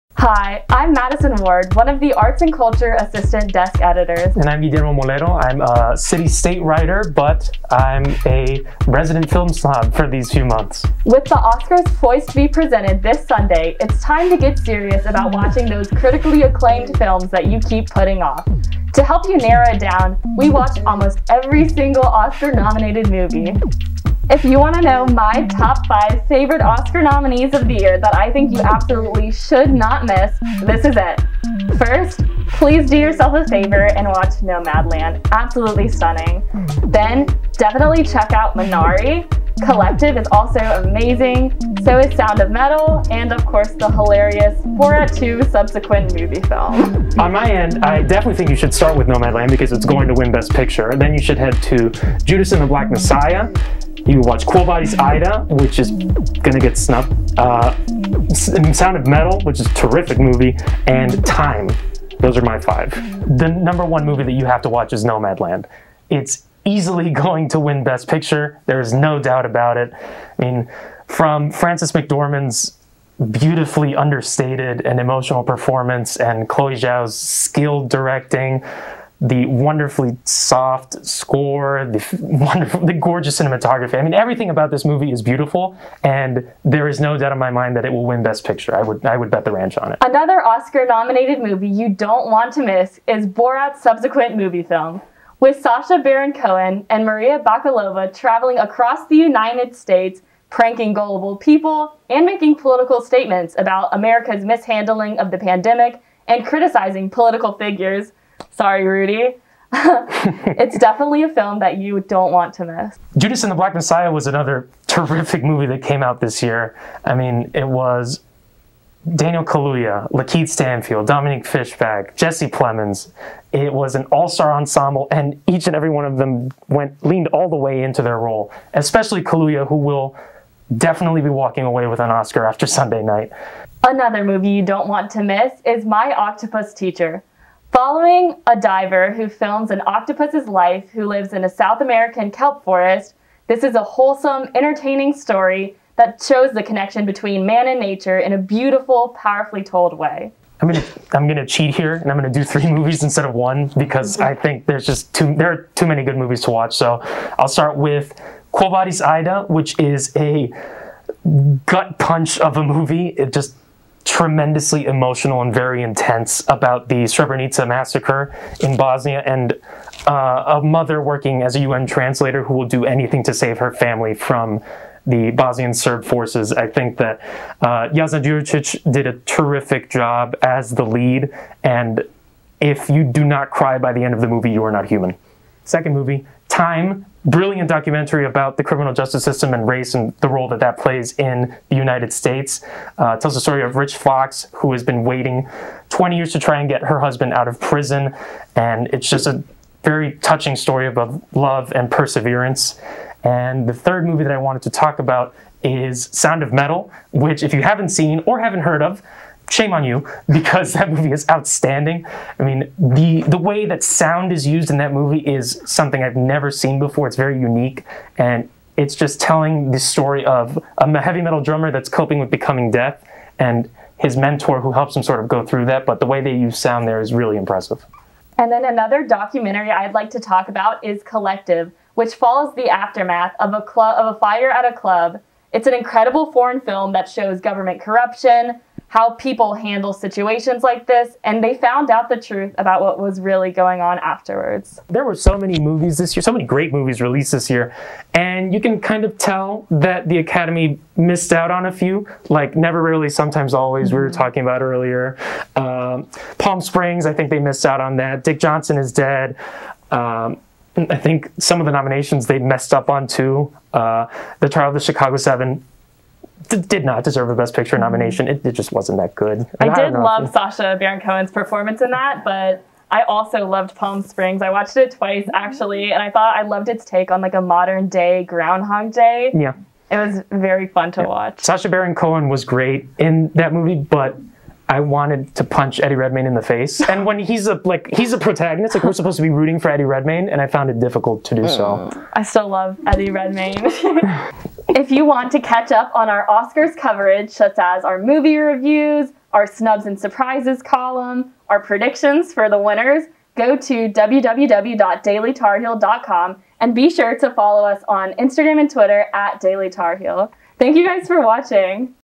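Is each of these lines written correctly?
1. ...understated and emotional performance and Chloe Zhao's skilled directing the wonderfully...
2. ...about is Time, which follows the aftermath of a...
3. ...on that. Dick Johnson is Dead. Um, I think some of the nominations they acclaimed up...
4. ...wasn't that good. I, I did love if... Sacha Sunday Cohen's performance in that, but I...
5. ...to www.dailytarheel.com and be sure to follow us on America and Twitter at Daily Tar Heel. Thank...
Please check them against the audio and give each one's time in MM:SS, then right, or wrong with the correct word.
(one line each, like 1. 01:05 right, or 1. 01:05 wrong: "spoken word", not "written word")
1. 01:13 right
2. 03:50 wrong: "Collective", not "Time"
3. 04:17 wrong: "messed", not "acclaimed"
4. 04:28 wrong: "Baron", not "Sunday"
5. 05:03 wrong: "Instagram", not "America".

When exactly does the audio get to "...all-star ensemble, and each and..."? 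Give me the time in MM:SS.
02:04.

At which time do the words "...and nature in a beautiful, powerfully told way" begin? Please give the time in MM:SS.
02:27.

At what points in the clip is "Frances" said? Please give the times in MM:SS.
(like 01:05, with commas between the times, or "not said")
01:11.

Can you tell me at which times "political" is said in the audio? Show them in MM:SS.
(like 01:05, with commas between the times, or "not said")
01:42, 01:47.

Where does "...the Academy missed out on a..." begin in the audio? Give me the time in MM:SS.
04:10.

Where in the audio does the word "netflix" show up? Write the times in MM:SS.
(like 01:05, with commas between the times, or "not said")
not said.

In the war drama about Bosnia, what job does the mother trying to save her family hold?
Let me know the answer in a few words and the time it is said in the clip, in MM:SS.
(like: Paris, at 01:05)
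UN translator, at 02:51.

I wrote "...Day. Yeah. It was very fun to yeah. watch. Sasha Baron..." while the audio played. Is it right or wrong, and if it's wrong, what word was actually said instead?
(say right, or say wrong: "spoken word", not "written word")
right.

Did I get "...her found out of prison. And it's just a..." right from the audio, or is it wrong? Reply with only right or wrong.
wrong.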